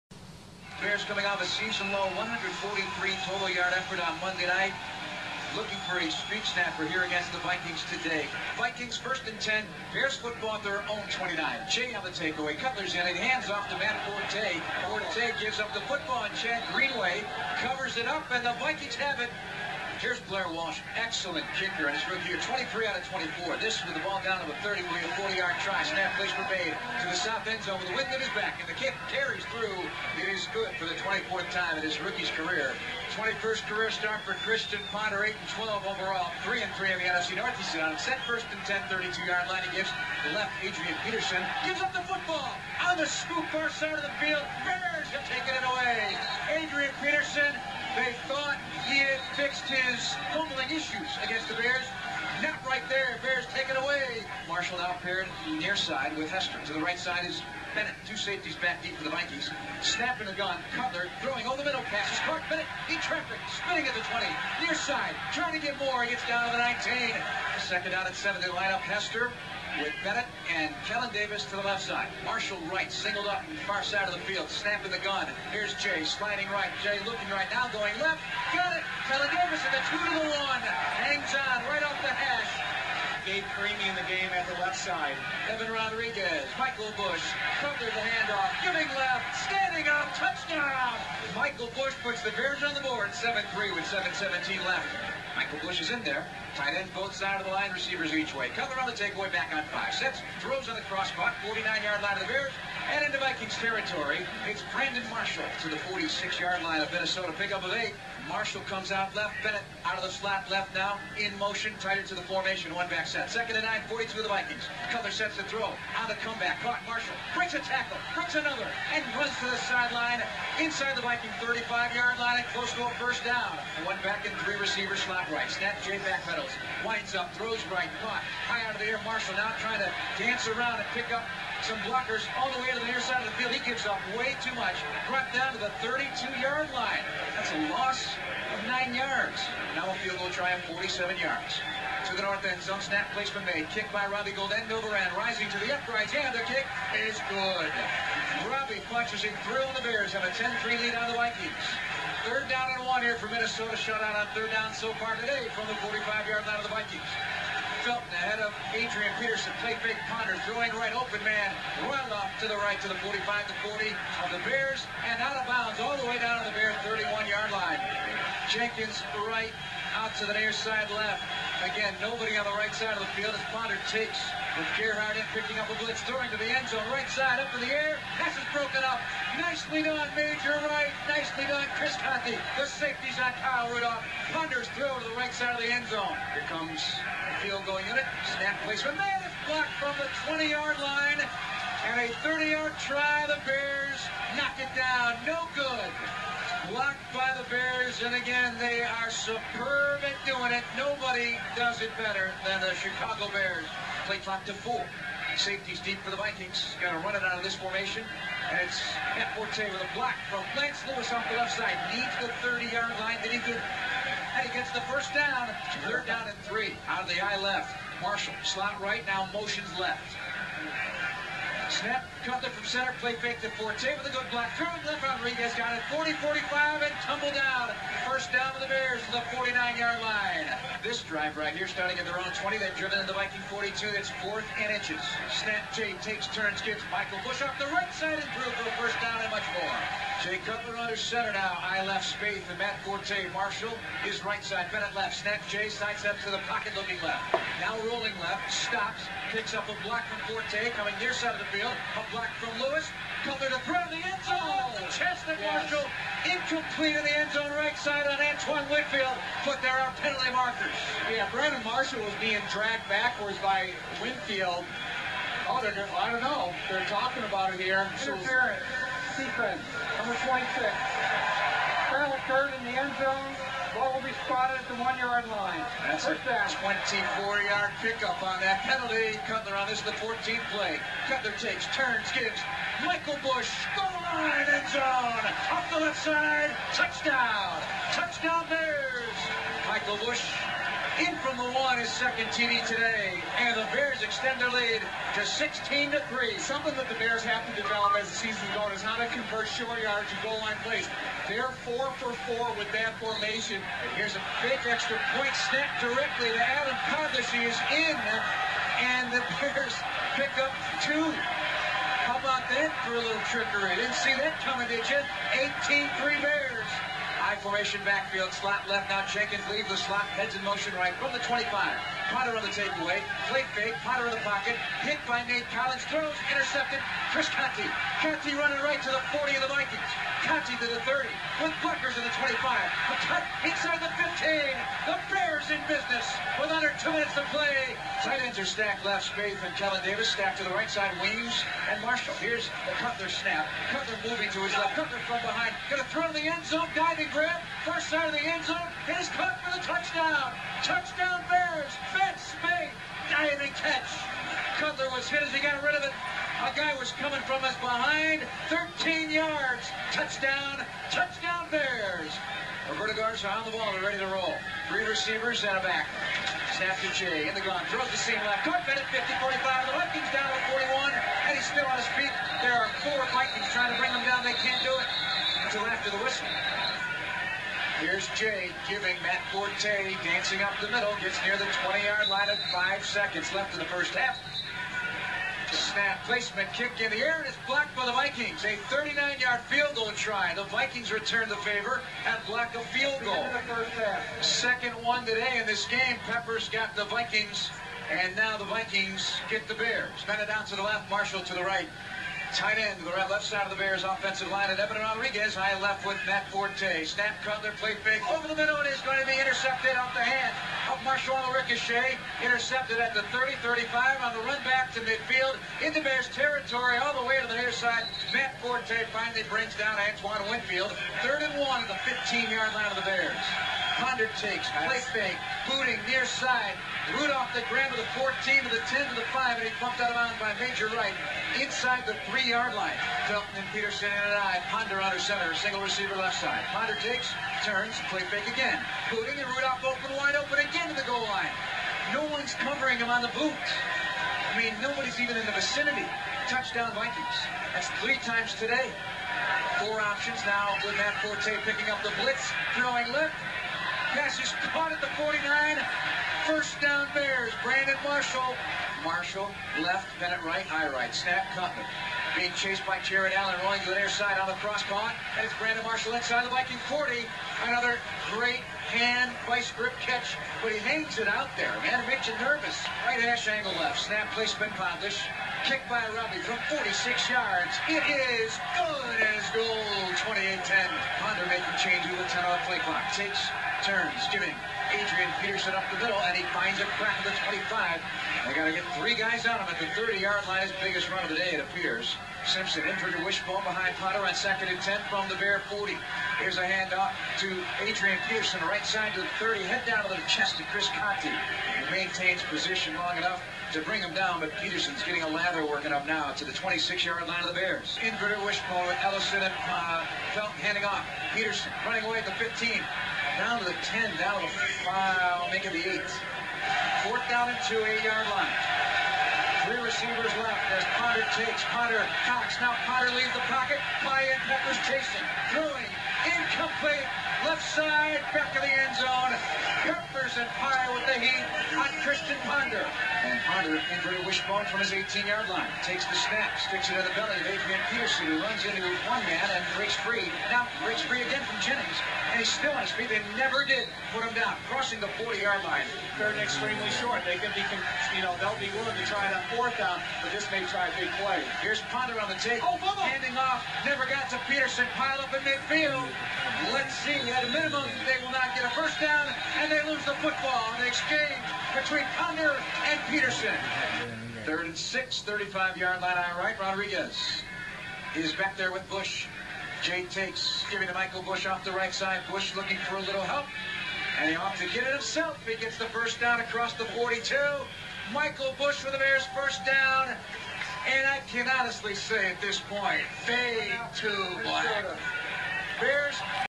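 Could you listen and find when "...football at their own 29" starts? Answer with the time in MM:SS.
00:10.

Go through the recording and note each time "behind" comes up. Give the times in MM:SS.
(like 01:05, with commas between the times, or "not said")
05:45, 05:57, 08:13.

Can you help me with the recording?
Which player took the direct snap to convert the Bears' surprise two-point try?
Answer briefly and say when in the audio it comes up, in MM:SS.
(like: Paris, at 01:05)
Adam Podlesh, at 05:06.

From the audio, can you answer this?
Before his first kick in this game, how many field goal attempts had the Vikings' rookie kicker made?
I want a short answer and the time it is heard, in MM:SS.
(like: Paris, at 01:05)
23 out of 24, at 00:22.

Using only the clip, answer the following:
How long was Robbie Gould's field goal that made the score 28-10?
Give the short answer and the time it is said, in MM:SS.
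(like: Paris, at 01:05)
46 yards, at 07:56.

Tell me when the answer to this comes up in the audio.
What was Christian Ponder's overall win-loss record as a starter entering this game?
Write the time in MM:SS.
00:35.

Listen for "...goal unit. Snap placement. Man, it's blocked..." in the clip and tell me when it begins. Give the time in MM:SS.
03:07.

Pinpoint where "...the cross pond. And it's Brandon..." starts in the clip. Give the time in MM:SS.
07:44.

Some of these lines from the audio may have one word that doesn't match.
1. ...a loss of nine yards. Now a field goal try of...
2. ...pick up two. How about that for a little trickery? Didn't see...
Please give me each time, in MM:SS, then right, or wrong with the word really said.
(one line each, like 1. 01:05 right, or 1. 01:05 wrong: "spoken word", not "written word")
1. 02:17 right
2. 05:10 right.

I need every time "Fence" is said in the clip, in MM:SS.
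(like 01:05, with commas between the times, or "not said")
05:51.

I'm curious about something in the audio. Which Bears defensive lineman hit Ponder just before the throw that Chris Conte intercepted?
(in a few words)
Nate Collins.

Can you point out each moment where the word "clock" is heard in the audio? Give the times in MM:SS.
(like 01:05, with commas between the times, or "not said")
03:24, 08:02.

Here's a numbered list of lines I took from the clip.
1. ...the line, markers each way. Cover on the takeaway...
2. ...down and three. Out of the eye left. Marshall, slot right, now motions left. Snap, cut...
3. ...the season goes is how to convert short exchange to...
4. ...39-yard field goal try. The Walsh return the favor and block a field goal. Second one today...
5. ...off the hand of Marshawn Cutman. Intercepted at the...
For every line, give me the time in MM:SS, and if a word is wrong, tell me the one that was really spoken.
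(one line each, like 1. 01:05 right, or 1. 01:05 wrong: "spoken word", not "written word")
1. 01:37 wrong: "receivers", not "markers"
2. 03:36 right
3. 04:58 wrong: "yardage", not "exchange"
4. 06:28 wrong: "Vikings", not "Walsh"
5. 06:49 wrong: "Ricochet", not "Cutman".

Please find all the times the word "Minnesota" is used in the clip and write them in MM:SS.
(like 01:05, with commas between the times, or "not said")
01:46, 02:33.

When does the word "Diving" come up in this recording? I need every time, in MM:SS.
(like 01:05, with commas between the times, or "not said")
05:46, 05:53.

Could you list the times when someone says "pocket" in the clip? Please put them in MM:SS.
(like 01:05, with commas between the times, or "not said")
04:06, 05:24, 08:43.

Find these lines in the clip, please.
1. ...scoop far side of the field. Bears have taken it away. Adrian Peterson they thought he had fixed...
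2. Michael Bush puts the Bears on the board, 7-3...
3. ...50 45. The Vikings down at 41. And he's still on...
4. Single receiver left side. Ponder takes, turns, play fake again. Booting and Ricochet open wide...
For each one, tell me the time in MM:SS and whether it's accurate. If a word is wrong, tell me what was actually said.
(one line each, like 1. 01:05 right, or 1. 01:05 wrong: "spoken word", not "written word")
1. 00:43 right
2. 01:31 right
3. 06:08 right
4. 07:15 wrong: "Rudolph", not "Ricochet".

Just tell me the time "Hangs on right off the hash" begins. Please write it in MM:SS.
01:20.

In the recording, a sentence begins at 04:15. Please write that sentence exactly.
Marshall incomplete in the end zone right side on Antoine Winfield.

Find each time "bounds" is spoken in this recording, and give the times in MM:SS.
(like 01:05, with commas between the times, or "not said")
02:45, 07:09.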